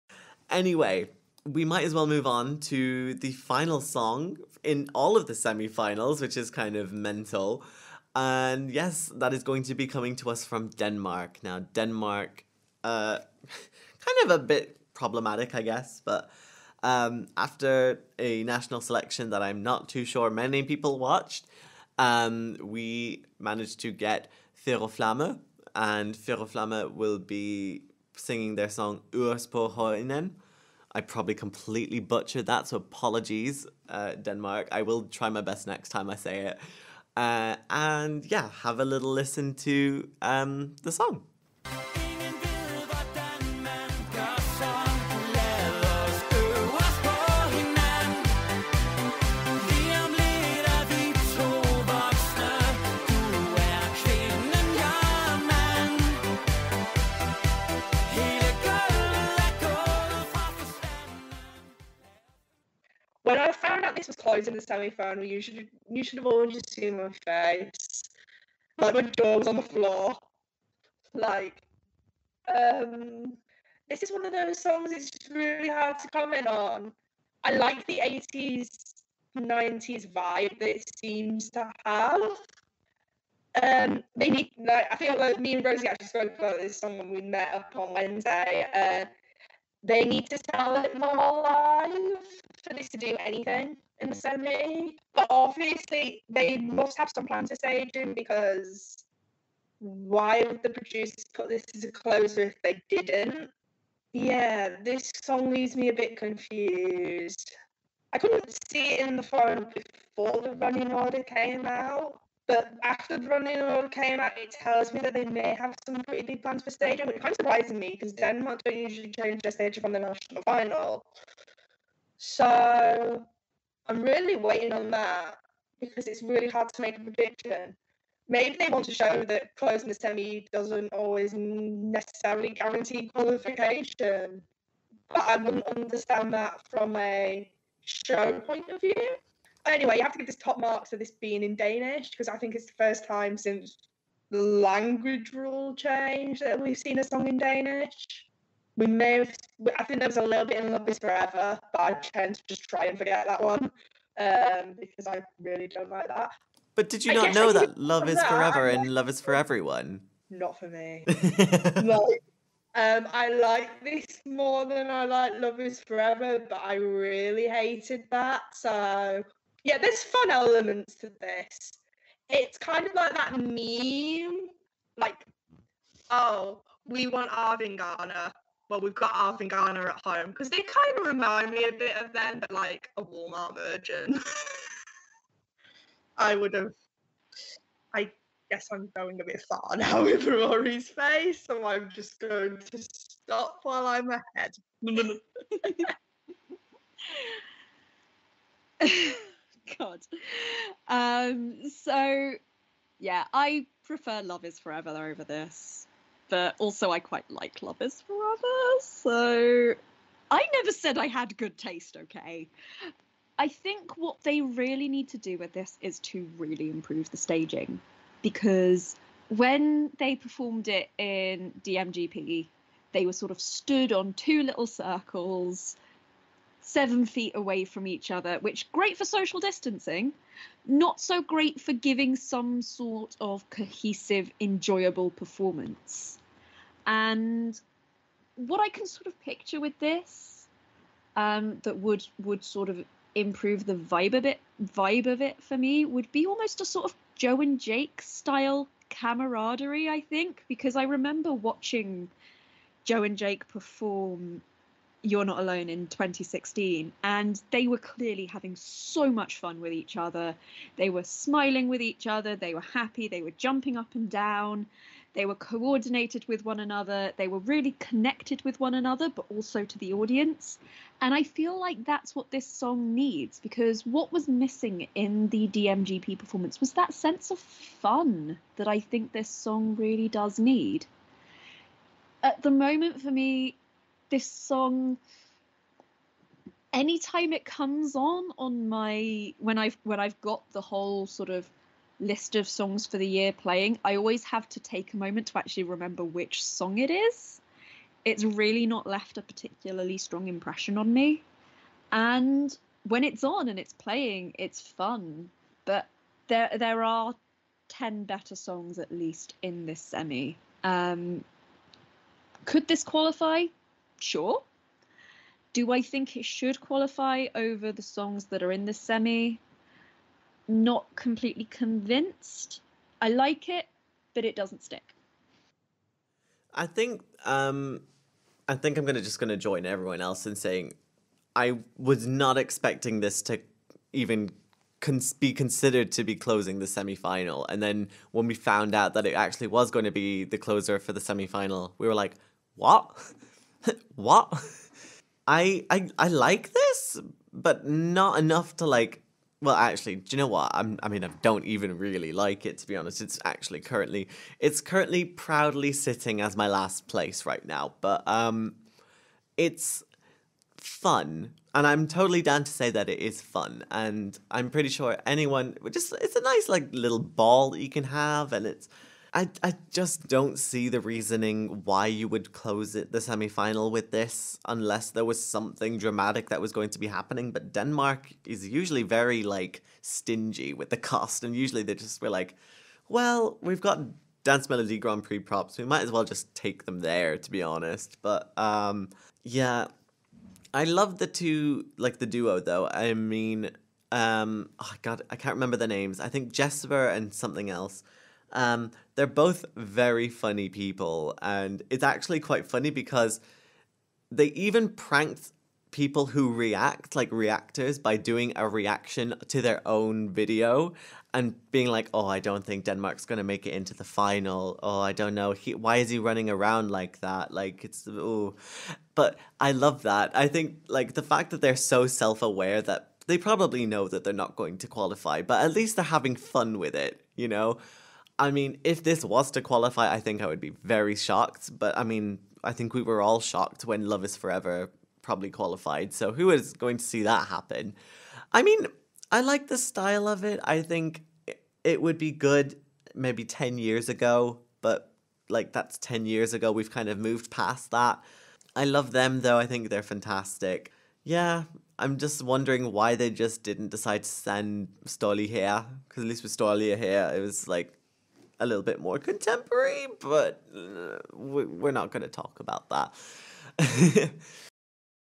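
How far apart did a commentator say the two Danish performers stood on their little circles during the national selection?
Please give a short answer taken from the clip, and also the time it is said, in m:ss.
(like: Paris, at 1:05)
7 feet, at 3:46.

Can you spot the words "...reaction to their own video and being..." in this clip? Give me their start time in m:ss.
6:48.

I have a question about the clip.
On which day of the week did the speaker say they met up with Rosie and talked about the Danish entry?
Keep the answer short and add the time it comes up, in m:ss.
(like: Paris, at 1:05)
Wednesday, at 1:27.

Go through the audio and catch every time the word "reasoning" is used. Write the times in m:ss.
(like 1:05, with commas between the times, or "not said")
6:10.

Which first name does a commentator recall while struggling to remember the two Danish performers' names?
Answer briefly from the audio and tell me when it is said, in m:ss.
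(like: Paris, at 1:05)
Jesper, at 6:36.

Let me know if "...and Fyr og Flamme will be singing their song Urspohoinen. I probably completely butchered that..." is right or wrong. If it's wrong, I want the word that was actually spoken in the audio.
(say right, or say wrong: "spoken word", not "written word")
right.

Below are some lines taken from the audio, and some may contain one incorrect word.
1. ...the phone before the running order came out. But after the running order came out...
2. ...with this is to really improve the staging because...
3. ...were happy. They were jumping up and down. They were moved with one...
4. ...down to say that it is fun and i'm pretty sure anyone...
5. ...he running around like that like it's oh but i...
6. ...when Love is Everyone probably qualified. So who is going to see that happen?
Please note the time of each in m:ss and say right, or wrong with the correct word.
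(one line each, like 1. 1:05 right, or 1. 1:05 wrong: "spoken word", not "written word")
1. 1:49 right
2. 3:35 right
3. 4:22 wrong: "coordinated", not "moved"
4. 6:02 right
5. 6:55 right
6. 7:13 wrong: "Forever", not "Everyone".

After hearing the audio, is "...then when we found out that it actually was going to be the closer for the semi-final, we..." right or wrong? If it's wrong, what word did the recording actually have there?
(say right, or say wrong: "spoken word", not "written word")
right.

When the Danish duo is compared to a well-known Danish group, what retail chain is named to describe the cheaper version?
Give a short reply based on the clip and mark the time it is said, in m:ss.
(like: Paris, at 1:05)
Walmart, at 3:03.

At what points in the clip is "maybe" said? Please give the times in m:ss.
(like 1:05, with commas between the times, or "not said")
2:08, 7:22.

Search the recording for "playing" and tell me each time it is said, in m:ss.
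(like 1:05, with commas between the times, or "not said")
4:53, 5:03.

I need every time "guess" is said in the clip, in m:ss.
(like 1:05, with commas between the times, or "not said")
0:15, 3:08.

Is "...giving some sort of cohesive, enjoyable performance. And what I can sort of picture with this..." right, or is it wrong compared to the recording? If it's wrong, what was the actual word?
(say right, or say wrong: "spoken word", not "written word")
right.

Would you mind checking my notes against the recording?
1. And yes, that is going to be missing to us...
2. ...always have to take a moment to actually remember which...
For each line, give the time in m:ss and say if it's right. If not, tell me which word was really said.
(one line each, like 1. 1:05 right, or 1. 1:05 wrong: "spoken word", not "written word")
1. 0:08 wrong: "coming", not "missing"
2. 4:53 right.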